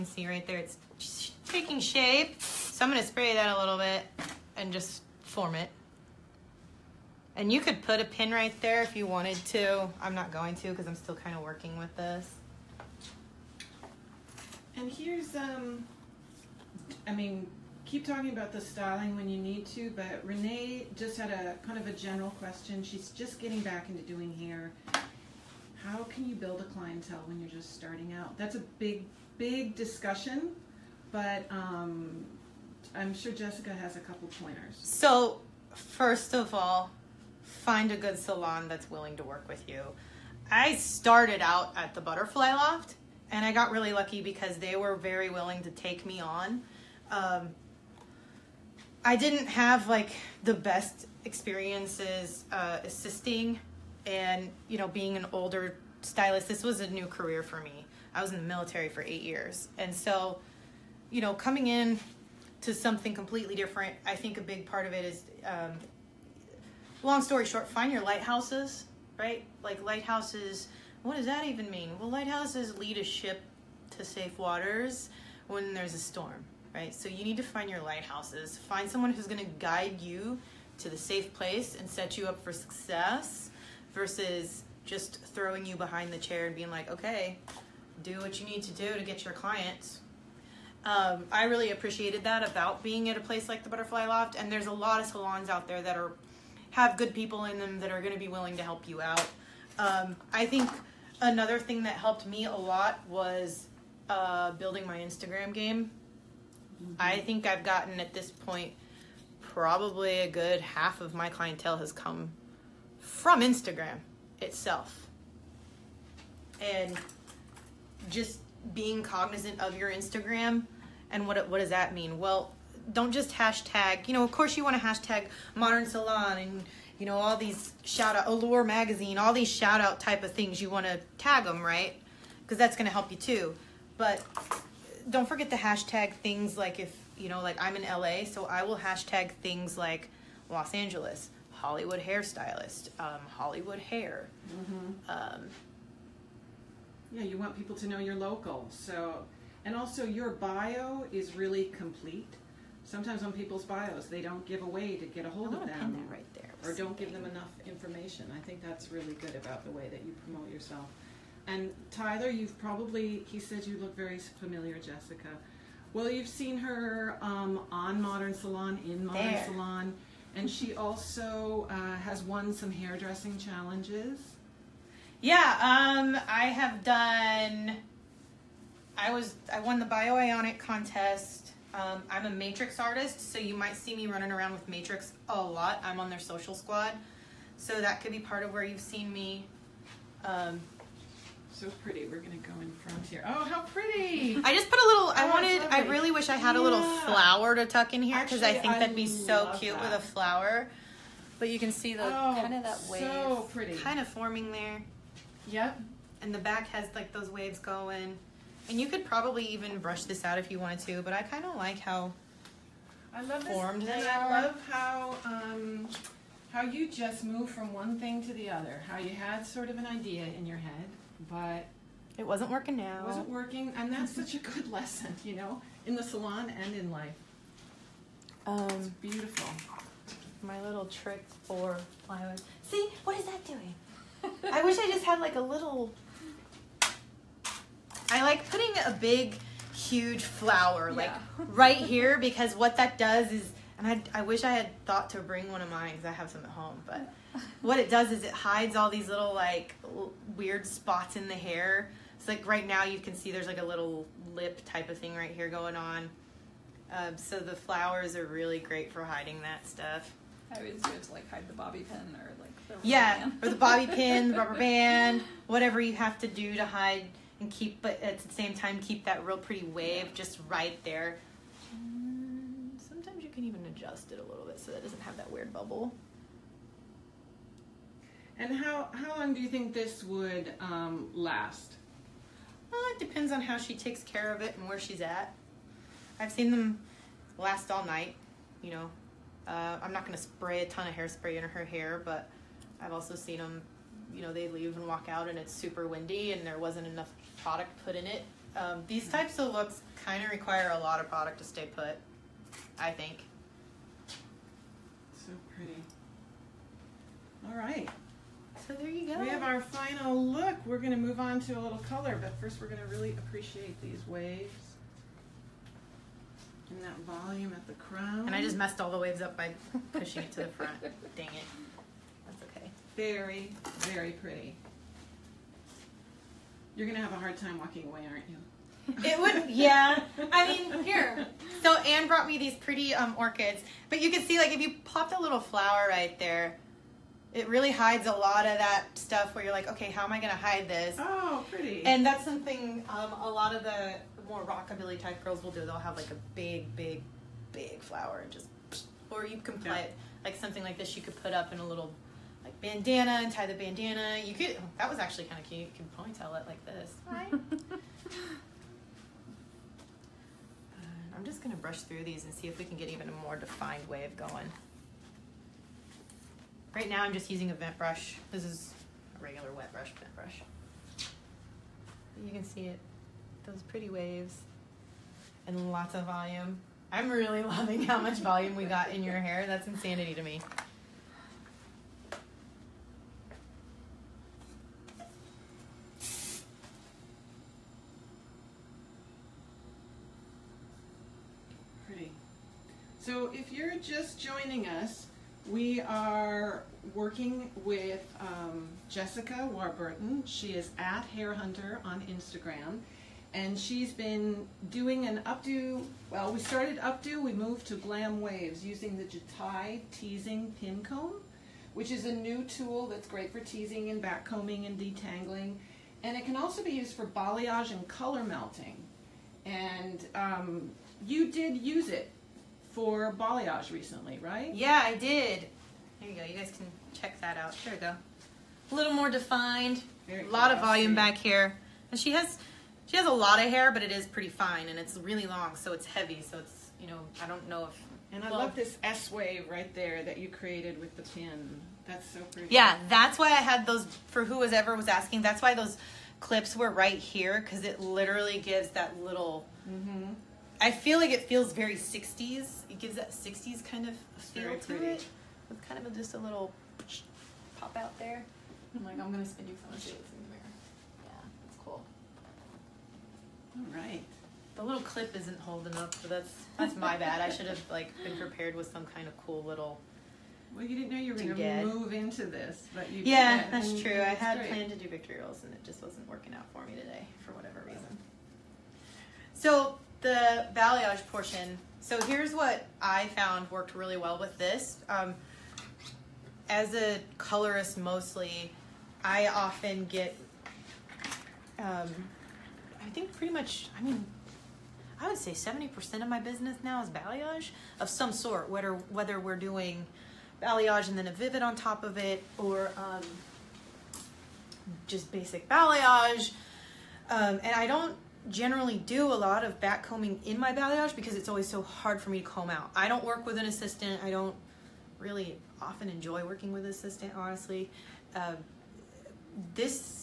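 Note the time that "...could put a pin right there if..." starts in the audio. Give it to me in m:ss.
0:07.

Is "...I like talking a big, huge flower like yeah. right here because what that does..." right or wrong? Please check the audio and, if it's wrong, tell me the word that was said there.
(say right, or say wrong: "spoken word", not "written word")
wrong: "putting", not "talking".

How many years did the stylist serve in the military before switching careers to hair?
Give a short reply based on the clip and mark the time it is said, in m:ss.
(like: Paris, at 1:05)
8, at 0:59.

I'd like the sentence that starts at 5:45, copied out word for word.
They'll have like a big, big, big flower and just, or you can play yeah.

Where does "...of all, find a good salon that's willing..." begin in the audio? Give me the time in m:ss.
0:36.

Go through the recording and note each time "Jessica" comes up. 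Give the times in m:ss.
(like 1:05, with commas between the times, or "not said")
0:33, 2:44, 6:38.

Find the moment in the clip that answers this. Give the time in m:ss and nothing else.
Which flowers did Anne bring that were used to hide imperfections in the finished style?
5:33.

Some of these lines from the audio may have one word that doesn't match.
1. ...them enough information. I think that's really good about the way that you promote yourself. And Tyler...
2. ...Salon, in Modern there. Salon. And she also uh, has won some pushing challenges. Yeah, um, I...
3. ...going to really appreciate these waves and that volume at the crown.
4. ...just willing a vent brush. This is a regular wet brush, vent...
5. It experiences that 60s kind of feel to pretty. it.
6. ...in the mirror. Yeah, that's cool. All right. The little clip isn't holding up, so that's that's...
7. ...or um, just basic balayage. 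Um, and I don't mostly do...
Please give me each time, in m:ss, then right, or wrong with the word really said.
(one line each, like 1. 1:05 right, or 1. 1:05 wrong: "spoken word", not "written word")
1. 2:37 right
2. 2:48 wrong: "hairdressing", not "pushing"
3. 5:12 right
4. 6:07 wrong: "using", not "willing"
5. 7:32 wrong: "gives", not "experiences"
6. 7:39 right
7. 8:22 wrong: "generally", not "mostly".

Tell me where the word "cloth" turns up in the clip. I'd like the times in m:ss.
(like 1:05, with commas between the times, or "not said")
not said.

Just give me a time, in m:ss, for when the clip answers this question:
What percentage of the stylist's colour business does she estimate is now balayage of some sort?
8:15.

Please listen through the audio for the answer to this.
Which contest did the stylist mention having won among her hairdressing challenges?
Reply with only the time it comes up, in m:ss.
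2:59.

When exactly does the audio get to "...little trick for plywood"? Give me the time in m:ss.
3:50.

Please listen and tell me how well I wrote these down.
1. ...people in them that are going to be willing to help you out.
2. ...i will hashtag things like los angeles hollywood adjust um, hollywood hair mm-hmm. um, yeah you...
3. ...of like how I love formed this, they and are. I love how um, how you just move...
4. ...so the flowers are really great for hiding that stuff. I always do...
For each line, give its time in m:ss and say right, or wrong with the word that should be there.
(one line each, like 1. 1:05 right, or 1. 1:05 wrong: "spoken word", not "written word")
1. 1:37 right
2. 2:18 wrong: "hairstylist", not "adjust"
3. 3:31 right
4. 4:17 right.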